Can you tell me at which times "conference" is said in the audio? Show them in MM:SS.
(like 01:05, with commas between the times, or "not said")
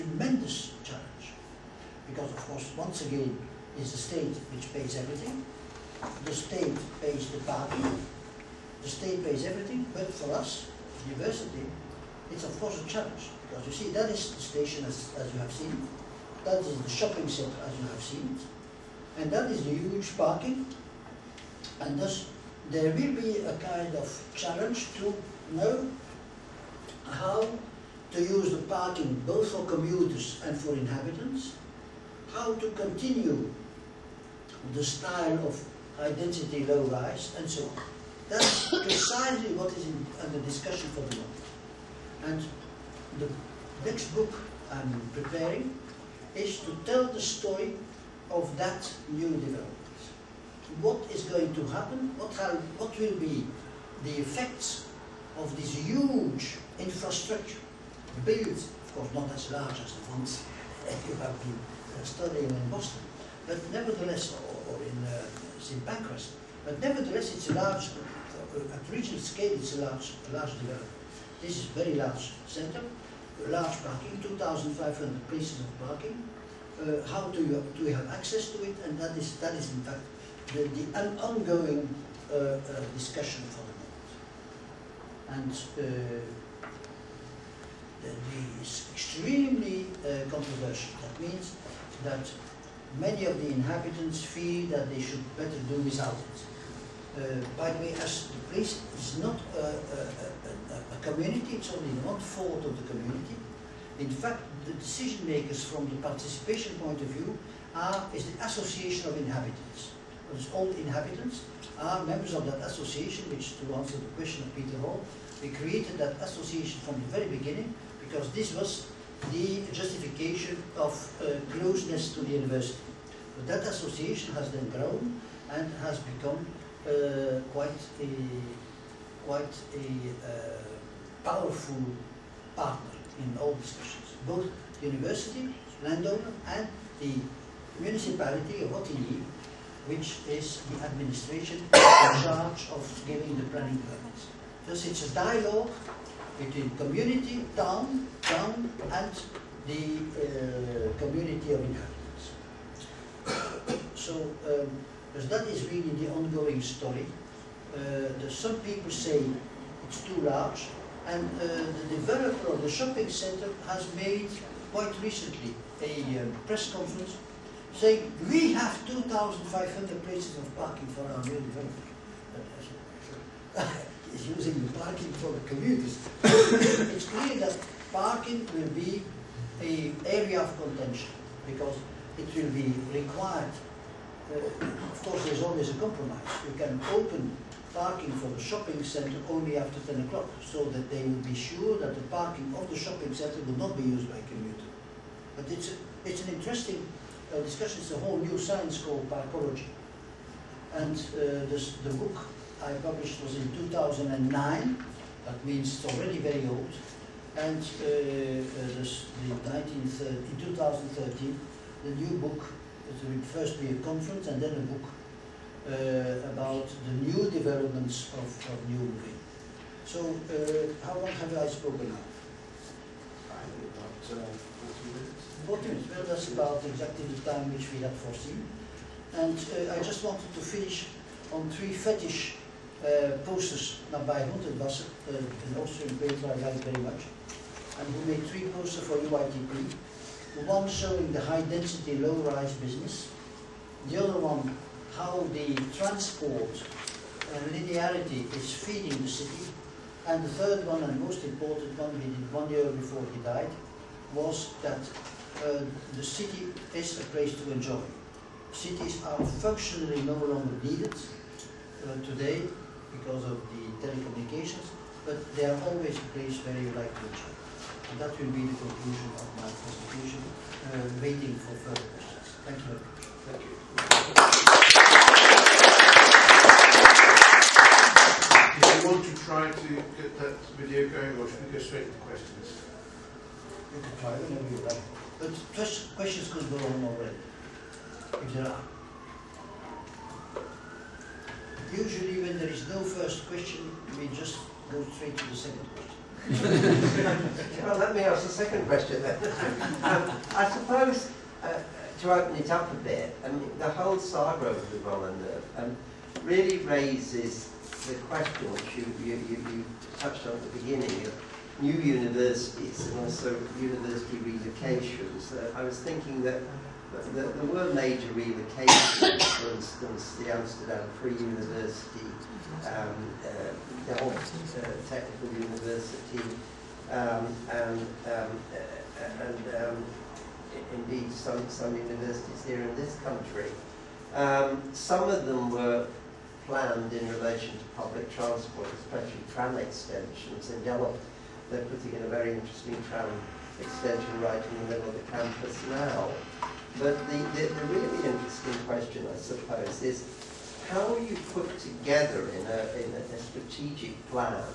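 02:46, 03:33.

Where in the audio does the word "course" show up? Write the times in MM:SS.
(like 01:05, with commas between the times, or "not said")
00:02, 00:12, 00:59, 03:05.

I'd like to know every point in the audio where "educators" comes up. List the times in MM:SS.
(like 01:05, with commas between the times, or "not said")
not said.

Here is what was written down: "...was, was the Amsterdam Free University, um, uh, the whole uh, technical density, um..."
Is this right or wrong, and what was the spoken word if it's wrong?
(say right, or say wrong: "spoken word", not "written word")
wrong: "university", not "density".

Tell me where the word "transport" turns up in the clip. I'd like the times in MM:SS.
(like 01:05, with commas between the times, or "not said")
04:05, 05:38.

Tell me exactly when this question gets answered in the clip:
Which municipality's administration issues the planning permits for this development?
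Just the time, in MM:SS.
02:18.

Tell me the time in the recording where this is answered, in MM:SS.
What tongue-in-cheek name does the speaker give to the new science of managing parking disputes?
03:19.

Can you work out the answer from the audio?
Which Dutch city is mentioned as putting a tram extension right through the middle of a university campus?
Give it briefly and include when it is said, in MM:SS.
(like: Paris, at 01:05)
Delft, at 05:40.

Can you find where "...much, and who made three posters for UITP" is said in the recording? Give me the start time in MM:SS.
03:56.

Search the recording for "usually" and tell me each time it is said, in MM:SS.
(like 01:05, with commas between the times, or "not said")
04:51.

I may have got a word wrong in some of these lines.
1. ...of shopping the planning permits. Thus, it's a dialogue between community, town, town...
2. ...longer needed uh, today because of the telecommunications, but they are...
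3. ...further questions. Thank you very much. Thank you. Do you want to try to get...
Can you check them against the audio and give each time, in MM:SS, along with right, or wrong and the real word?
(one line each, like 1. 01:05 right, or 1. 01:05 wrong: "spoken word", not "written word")
1. 02:22 wrong: "giving", not "shopping"
2. 04:20 right
3. 04:31 right.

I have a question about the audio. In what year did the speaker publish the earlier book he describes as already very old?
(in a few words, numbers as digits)
2009.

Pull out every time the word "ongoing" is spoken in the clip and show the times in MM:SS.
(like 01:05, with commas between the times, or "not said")
01:21, 02:36.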